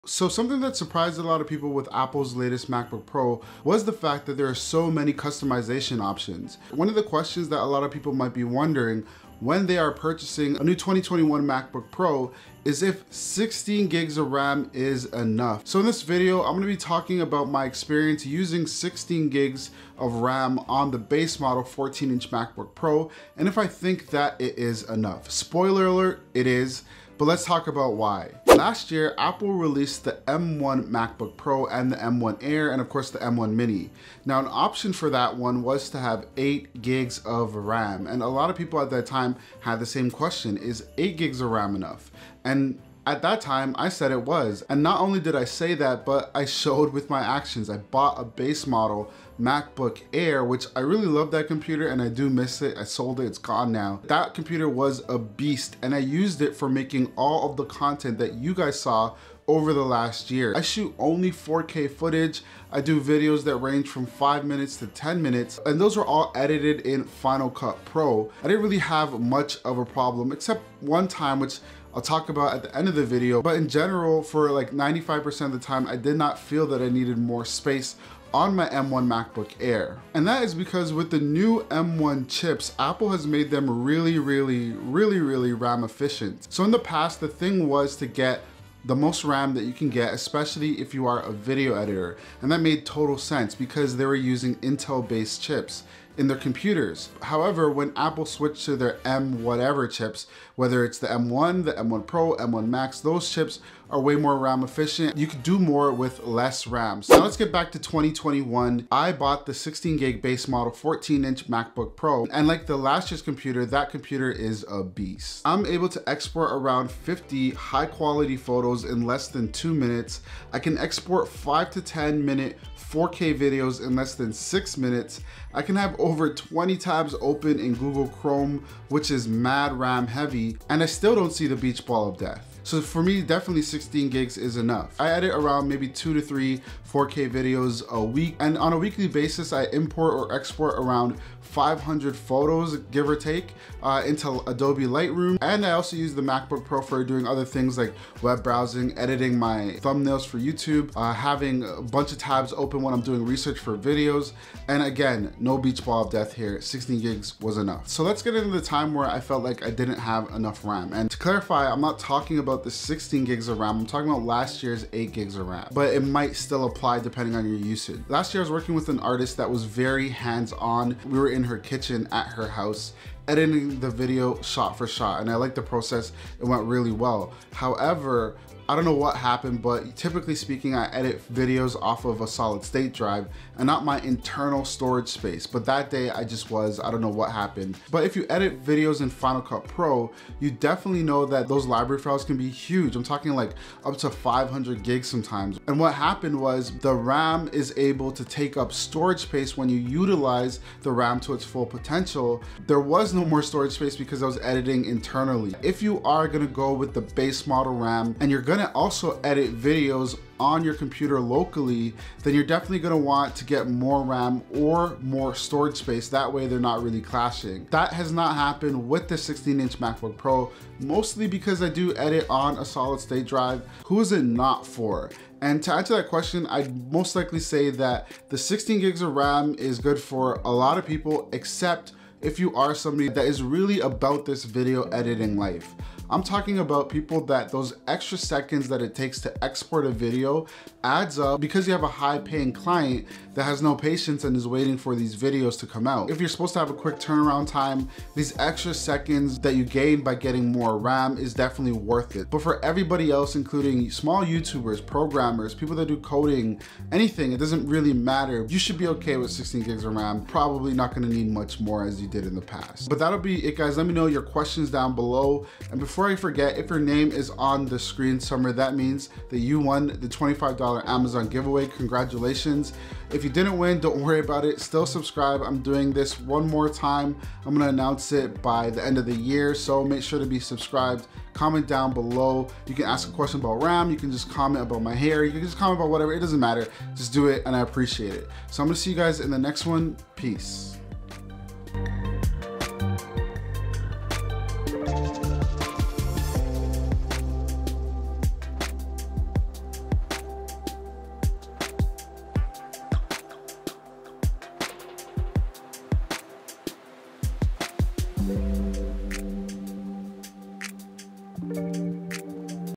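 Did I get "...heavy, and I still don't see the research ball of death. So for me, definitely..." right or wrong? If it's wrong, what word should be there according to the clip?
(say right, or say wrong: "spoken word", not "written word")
wrong: "beach", not "research".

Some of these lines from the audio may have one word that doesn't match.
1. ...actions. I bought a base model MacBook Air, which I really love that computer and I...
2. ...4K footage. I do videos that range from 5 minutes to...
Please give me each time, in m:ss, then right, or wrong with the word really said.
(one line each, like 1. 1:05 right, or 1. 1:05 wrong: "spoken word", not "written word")
1. 0:47 right
2. 1:01 right.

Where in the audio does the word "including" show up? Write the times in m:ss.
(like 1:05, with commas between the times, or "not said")
4:13.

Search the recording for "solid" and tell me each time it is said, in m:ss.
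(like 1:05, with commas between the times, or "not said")
3:02, 3:42.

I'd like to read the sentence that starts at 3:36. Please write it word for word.
That way they're not really clashing.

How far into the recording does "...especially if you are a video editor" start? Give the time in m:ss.
1:30.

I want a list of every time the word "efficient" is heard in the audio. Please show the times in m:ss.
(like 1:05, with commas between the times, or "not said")
1:25, 1:44.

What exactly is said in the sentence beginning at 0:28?
Last year, Apple released the M1 MacBook Pro and the M1 Air, and of course the M1 Mini.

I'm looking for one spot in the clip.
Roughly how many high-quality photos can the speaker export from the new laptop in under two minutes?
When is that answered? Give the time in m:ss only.
1:56.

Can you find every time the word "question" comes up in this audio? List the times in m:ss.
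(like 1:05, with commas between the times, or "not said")
0:07, 0:40, 3:46, 4:24, 4:43.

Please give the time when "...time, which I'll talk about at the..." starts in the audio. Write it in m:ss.
1:11.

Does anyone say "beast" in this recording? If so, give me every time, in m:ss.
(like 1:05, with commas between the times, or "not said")
0:55, 1:54.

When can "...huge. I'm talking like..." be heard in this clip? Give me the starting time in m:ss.
3:12.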